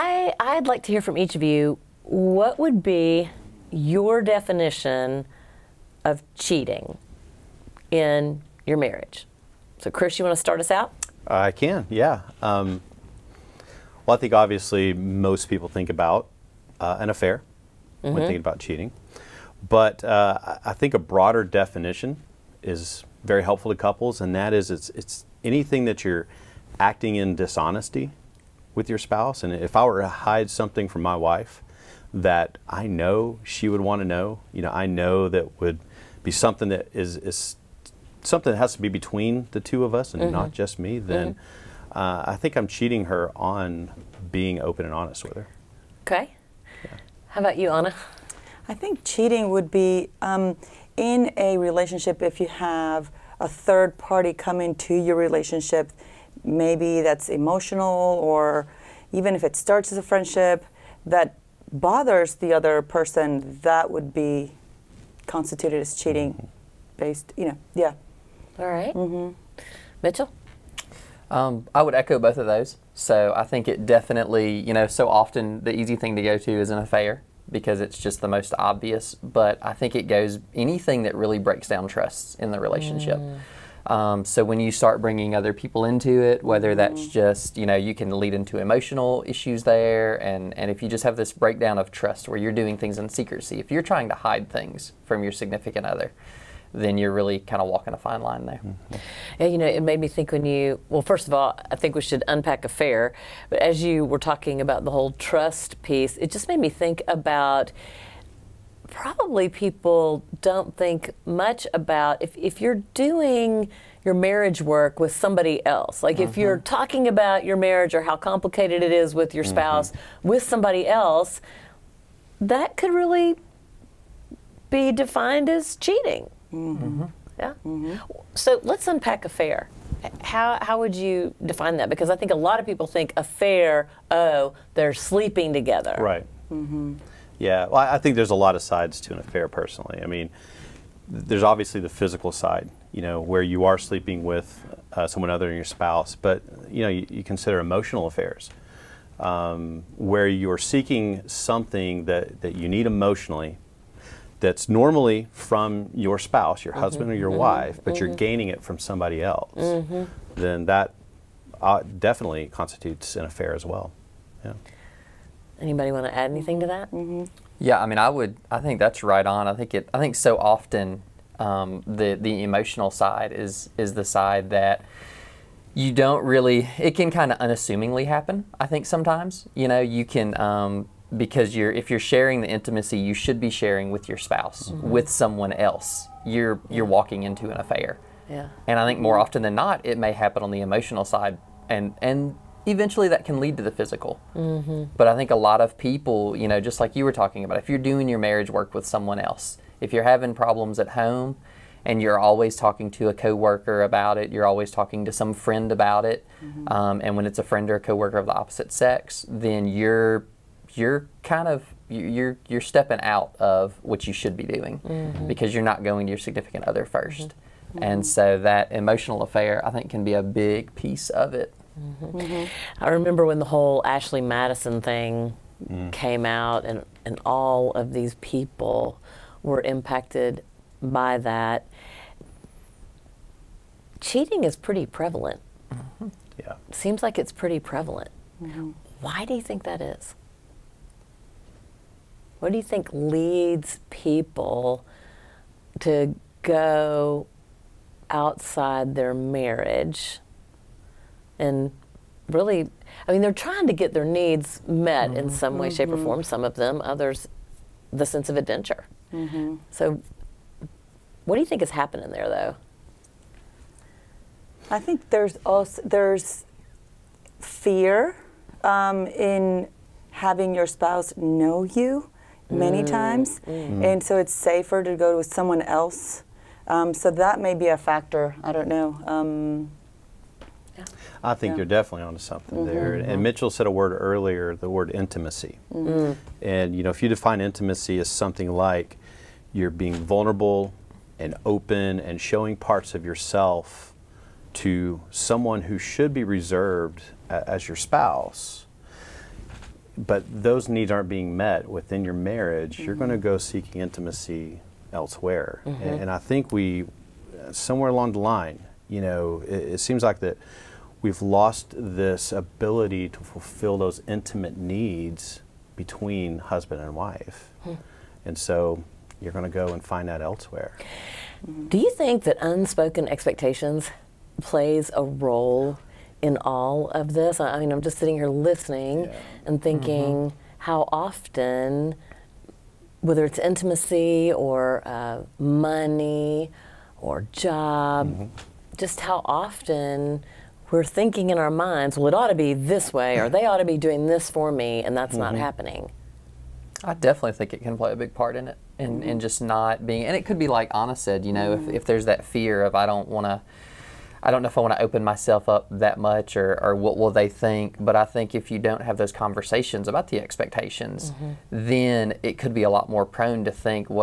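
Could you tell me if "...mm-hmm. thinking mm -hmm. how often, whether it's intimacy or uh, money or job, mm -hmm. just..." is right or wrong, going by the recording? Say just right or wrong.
right.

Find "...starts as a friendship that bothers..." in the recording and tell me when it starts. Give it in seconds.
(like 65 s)
59 s.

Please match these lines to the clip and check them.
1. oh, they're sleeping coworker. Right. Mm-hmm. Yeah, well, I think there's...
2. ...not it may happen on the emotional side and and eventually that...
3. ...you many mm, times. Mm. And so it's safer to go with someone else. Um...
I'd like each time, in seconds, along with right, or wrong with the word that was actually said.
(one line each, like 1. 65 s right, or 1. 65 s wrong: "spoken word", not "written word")
1. 134 s wrong: "together", not "coworker"
2. 189 s right
3. 271 s right.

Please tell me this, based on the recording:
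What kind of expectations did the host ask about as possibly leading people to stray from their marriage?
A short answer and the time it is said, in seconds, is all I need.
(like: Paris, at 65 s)
unspoken expectations, at 322 s.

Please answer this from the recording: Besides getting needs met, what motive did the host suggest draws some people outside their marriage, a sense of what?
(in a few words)
adventure.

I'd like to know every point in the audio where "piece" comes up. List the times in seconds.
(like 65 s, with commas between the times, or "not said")
105 s, 220 s.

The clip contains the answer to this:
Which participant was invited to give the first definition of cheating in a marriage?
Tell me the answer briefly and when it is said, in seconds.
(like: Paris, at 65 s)
Chris, at 9 s.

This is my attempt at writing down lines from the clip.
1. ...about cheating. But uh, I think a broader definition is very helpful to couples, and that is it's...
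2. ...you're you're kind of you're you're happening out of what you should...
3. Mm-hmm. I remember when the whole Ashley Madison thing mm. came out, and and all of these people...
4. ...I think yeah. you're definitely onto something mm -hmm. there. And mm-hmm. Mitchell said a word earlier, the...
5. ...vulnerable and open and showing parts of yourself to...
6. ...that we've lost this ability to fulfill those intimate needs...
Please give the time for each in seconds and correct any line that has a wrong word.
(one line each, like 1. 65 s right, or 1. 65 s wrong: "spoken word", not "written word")
1. 18 s right
2. 209 s wrong: "stepping", not "happening"
3. 222 s right
4. 281 s right
5. 290 s right
6. 310 s right.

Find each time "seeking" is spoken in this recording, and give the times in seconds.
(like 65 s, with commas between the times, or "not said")
150 s, 303 s.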